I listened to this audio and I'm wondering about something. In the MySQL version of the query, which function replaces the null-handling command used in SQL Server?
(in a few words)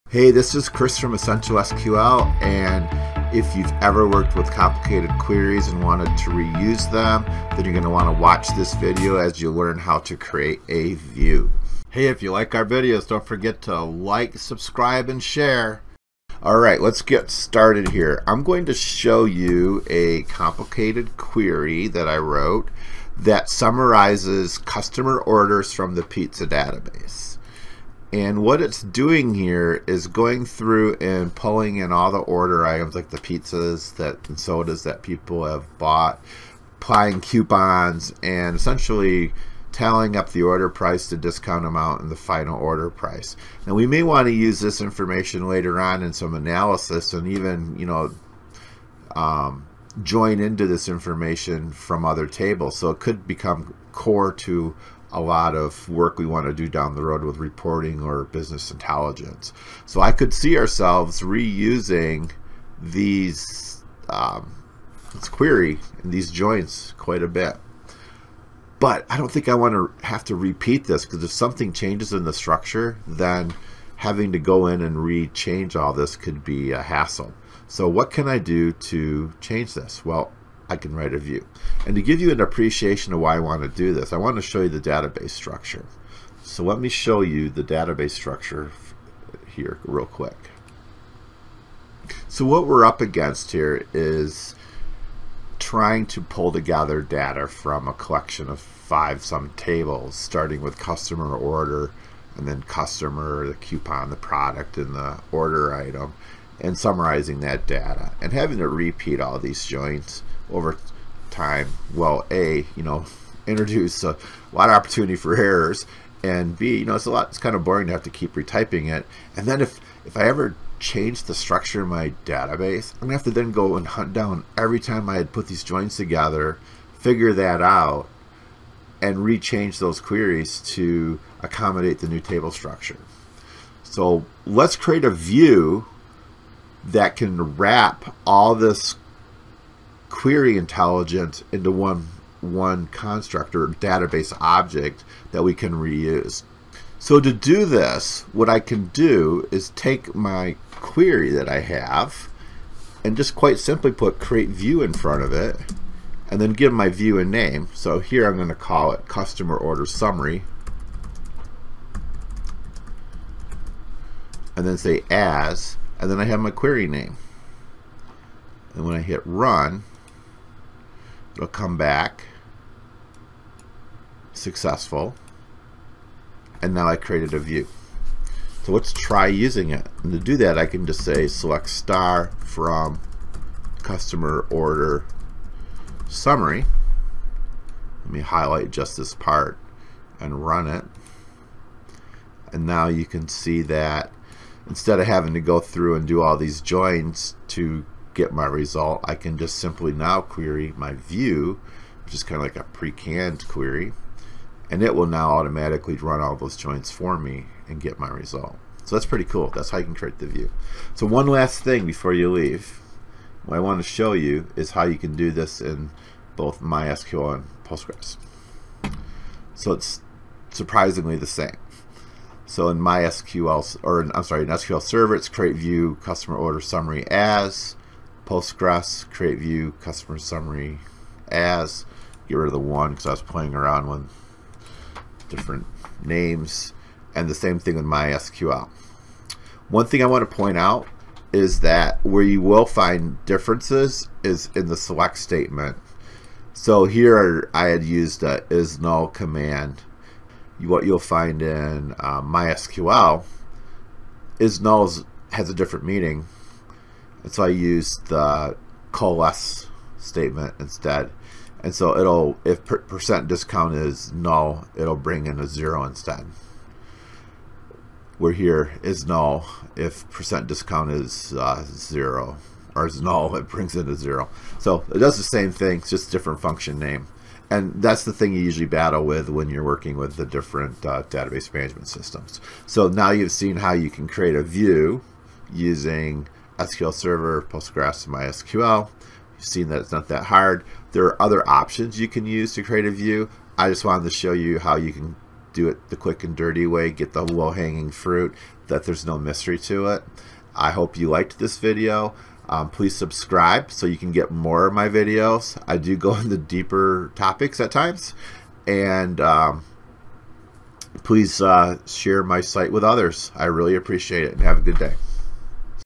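coalesce.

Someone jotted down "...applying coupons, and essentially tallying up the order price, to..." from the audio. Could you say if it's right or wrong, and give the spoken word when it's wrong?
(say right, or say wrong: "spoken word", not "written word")
right.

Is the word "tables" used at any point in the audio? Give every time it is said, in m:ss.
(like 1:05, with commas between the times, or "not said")
0:52, 1:39, 2:12.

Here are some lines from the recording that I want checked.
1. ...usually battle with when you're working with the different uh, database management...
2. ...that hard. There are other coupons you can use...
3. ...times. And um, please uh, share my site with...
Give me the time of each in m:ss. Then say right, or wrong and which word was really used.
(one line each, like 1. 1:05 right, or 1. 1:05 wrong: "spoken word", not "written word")
1. 4:38 right
2. 4:50 wrong: "options", not "coupons"
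3. 5:07 right.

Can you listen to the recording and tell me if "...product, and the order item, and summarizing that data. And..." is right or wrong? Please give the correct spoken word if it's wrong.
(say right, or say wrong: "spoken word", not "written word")
right.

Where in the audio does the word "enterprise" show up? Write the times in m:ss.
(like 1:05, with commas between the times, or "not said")
not said.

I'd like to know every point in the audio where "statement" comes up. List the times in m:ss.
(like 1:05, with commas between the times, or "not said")
4:05, 4:19.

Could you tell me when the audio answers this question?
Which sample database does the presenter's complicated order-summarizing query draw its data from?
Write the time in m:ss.
0:26.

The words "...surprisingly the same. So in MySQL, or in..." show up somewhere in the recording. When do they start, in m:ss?
3:40.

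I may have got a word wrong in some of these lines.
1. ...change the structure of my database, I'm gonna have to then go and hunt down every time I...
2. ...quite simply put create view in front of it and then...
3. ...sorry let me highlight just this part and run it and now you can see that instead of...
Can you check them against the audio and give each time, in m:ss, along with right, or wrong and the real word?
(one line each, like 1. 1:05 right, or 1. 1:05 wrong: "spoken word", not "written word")
1. 2:00 right
2. 2:33 right
3. 3:06 wrong: "summary", not "sorry".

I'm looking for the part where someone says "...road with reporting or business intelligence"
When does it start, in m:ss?
0:57.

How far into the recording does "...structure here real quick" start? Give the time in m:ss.
1:28.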